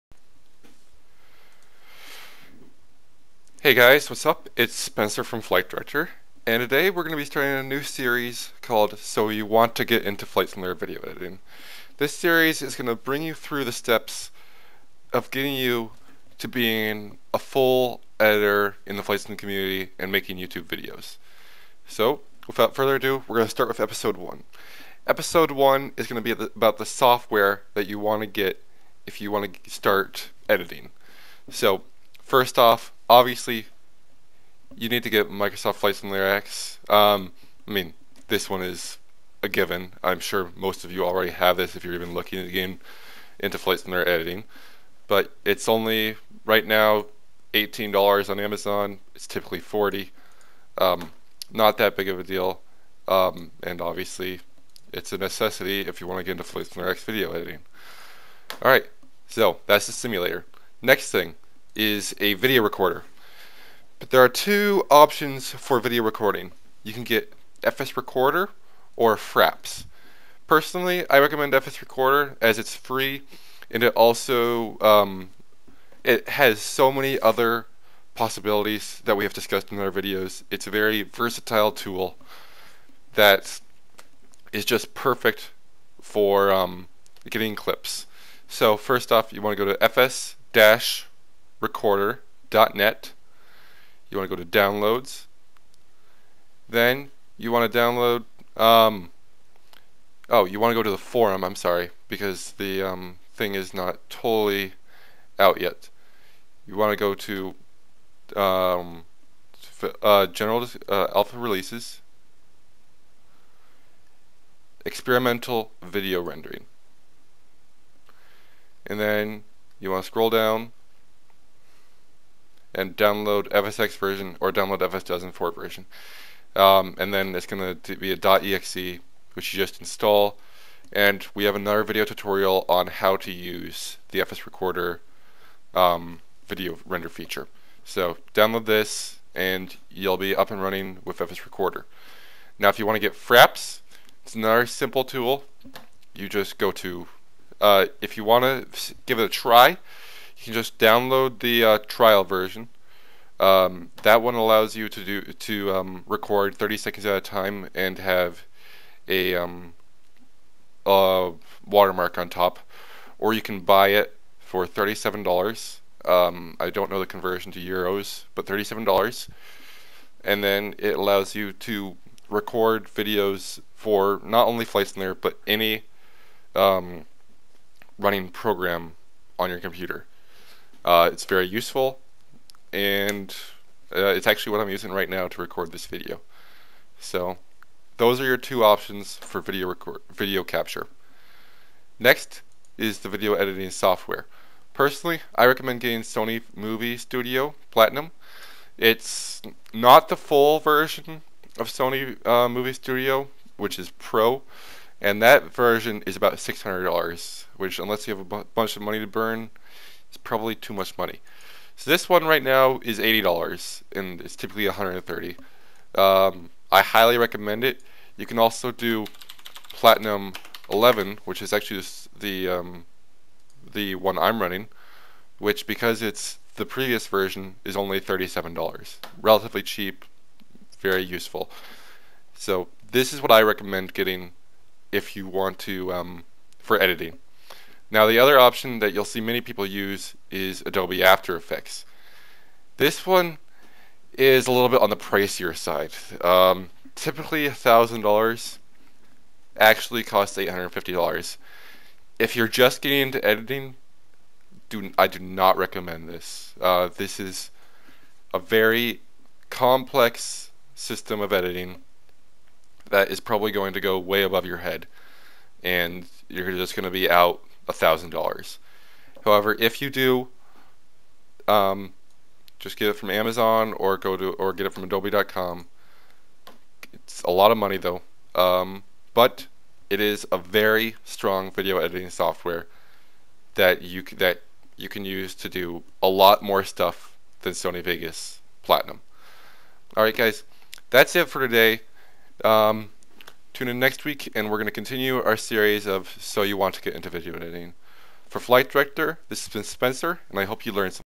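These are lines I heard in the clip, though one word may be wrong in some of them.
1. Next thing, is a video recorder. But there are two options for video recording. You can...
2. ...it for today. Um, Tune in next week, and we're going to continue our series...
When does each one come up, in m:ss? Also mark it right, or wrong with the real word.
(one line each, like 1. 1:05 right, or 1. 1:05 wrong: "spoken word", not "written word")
1. 1:00 right
2. 4:51 right.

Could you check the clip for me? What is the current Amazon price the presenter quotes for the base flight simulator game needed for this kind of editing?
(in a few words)
$18.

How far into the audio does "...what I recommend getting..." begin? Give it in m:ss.
3:53.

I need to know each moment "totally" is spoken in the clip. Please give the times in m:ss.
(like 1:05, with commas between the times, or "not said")
1:44.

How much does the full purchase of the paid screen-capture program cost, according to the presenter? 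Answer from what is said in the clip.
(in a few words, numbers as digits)
$37.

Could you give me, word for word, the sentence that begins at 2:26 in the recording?
You just go to, uh, if you want to give it a try, you can just download the uh, trial version.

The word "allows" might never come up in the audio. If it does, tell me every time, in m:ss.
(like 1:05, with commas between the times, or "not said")
2:34, 2:50.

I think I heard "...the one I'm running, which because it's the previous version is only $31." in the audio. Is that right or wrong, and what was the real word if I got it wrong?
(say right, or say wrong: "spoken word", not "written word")
wrong: "37", not "31".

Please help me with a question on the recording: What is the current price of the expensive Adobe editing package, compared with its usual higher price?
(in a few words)
$850.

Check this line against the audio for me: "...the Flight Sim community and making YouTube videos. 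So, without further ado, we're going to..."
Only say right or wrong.
right.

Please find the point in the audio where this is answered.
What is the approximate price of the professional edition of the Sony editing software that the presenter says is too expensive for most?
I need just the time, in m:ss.
3:26.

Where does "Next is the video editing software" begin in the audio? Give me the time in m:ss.
3:11.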